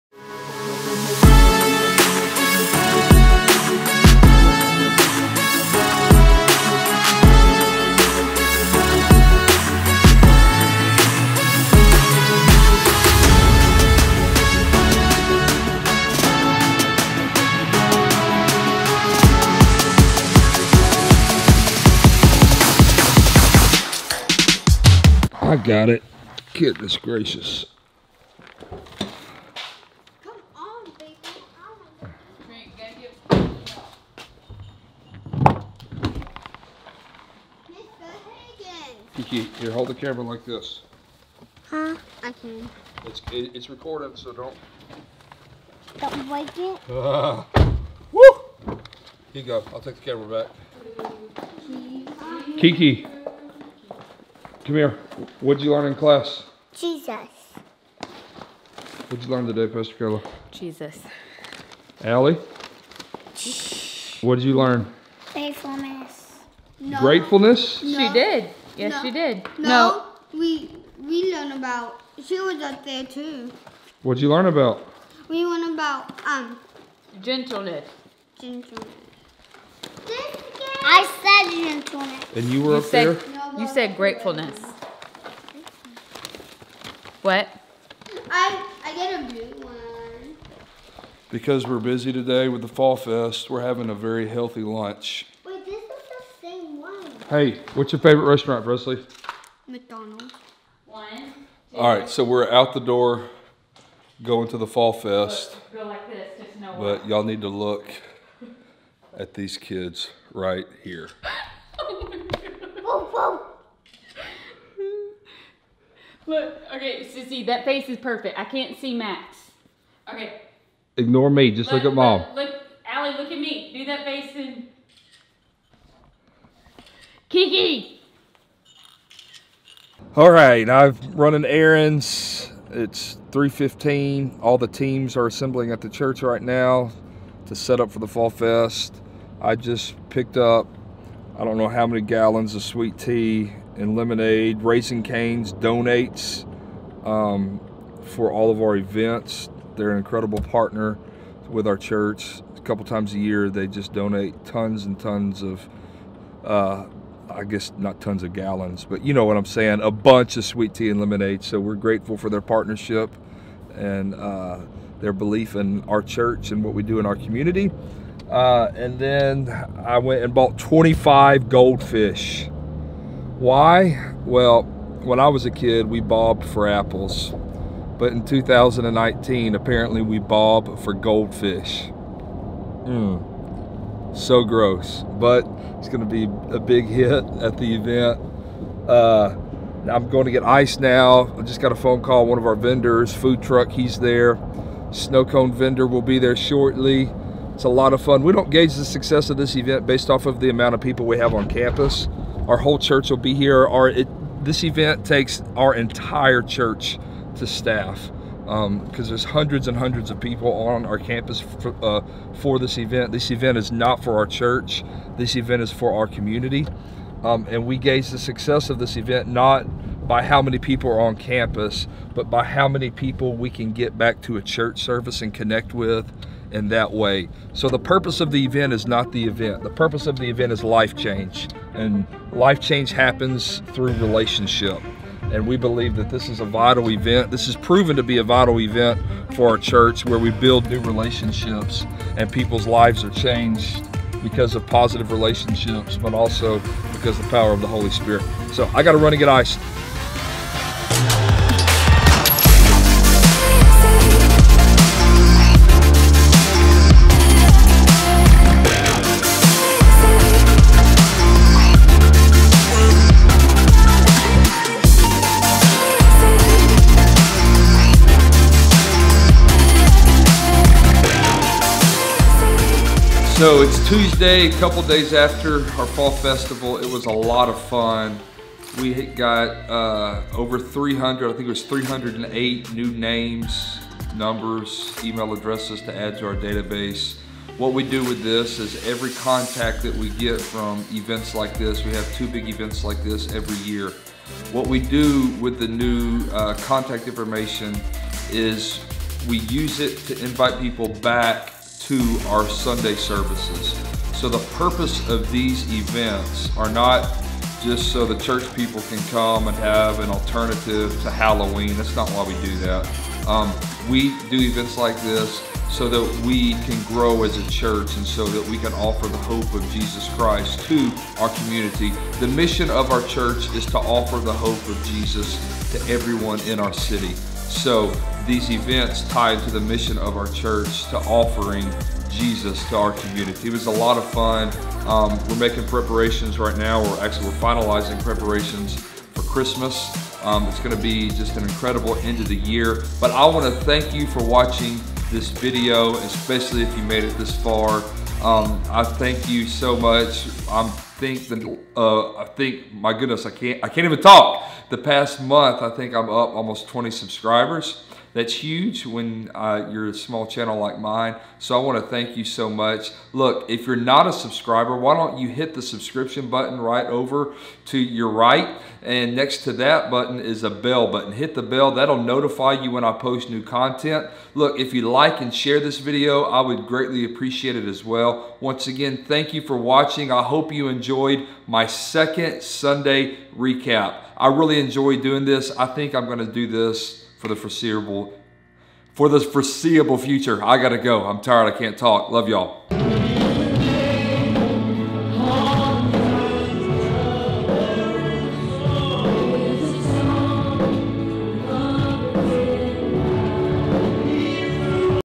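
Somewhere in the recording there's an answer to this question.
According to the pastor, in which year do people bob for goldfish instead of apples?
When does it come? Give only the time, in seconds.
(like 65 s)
178 s.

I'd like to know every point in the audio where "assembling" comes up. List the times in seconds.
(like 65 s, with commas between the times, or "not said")
135 s.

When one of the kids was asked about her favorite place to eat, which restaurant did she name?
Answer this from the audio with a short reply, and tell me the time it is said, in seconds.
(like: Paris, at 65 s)
McDonald's, at 99 s.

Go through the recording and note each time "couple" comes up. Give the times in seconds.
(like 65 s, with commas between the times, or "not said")
152 s, 274 s.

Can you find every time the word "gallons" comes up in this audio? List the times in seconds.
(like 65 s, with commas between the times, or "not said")
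142 s, 158 s.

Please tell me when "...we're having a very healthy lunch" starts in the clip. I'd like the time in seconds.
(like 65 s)
93 s.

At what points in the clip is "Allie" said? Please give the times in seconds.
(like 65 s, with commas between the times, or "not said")
62 s, 122 s.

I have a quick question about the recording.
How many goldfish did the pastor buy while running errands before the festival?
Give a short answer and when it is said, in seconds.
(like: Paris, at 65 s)
25, at 170 s.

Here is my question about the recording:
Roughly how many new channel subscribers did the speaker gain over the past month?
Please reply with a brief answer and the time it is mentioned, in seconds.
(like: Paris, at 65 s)
20, at 356 s.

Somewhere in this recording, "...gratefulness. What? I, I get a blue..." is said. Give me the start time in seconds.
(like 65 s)
83 s.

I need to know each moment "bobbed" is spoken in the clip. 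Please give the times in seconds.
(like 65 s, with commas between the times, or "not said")
175 s.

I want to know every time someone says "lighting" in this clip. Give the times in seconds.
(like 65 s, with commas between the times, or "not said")
not said.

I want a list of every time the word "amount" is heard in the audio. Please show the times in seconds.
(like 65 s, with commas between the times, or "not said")
200 s.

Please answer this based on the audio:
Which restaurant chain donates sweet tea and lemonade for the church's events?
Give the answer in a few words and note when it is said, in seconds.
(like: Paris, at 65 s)
Raising Cane's, at 144 s.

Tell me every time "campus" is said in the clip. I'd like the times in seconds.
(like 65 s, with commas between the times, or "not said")
201 s, 210 s, 221 s.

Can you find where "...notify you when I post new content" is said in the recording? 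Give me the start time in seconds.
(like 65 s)
372 s.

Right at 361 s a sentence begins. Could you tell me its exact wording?
So I want to thank you so much.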